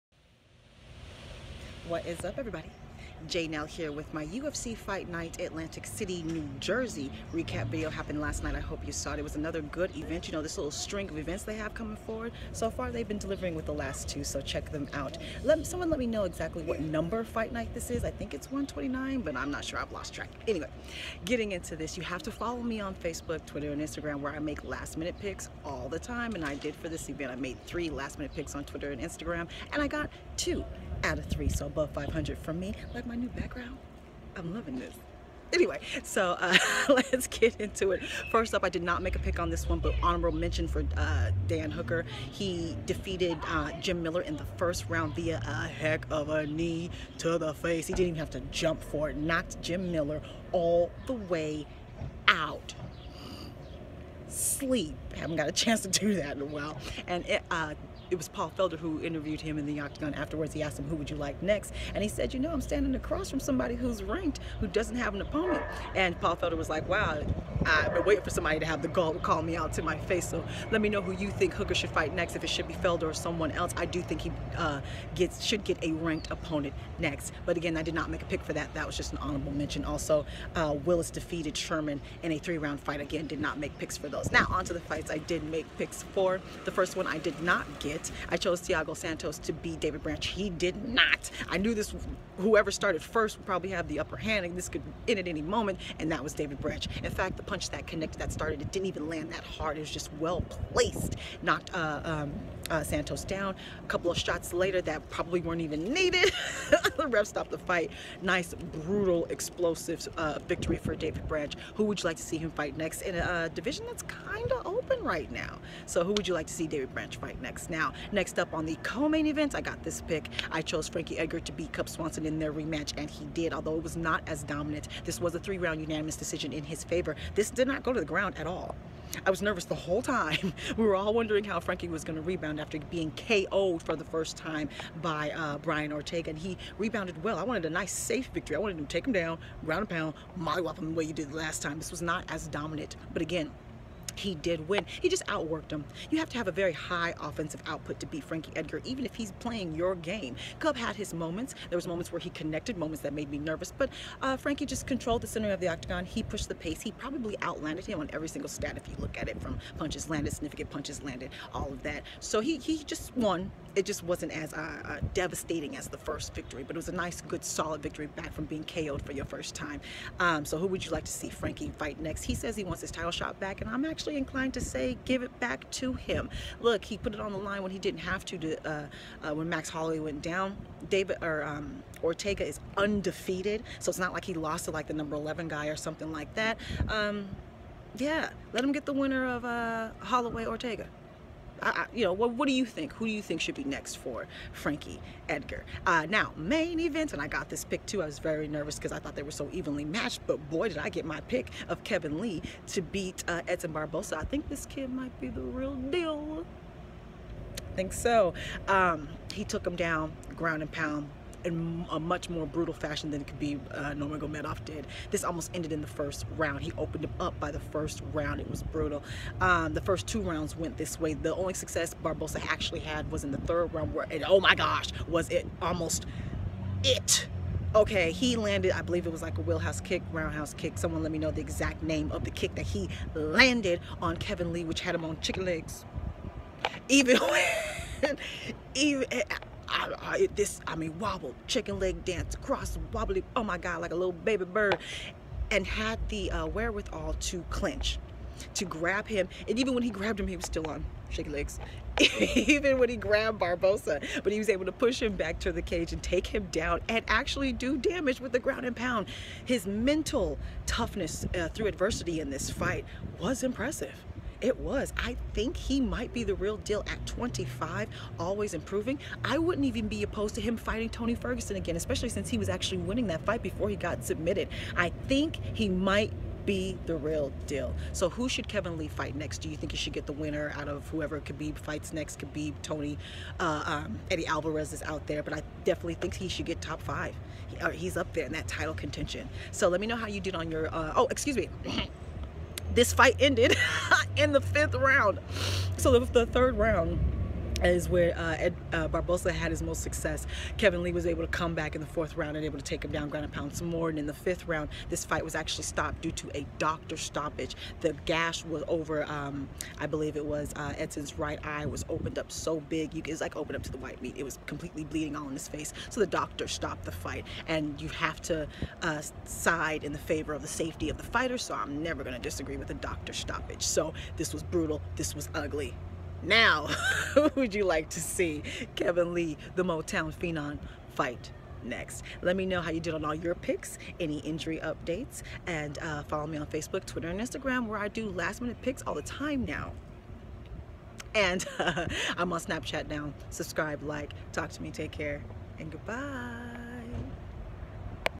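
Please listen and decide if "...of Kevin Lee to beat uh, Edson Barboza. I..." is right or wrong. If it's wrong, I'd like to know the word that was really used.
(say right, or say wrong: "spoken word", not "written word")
right.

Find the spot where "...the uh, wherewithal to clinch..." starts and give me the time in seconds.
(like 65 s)
246 s.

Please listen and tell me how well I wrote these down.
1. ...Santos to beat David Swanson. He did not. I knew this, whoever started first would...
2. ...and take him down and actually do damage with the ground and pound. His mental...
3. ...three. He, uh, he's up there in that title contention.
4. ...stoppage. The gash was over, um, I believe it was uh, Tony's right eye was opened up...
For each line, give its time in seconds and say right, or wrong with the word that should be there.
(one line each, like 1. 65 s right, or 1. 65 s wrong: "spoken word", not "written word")
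1. 88 s wrong: "Branch", not "Swanson"
2. 255 s right
3. 286 s wrong: "five", not "three"
4. 306 s wrong: "Edson", not "Tony".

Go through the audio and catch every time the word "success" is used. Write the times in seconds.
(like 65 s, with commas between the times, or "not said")
221 s, 299 s.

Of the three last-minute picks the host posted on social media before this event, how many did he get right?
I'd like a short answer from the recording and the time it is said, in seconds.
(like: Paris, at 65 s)
2, at 30 s.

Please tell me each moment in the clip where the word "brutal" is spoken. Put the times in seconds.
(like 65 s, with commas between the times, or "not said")
108 s, 212 s, 218 s, 324 s.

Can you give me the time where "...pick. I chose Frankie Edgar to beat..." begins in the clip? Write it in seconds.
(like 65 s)
119 s.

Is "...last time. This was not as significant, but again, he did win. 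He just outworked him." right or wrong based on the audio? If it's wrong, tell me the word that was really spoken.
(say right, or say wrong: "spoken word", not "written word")
wrong: "dominant", not "significant".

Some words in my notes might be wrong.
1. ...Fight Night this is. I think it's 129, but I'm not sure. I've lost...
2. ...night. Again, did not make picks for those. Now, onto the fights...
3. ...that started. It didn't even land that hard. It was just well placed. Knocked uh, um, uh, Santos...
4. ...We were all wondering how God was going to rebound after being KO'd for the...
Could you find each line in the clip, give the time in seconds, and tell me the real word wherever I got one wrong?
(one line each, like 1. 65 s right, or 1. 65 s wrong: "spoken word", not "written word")
1. 17 s right
2. 82 s wrong: "fight", not "night"
3. 98 s right
4. 130 s wrong: "Frankie", not "God".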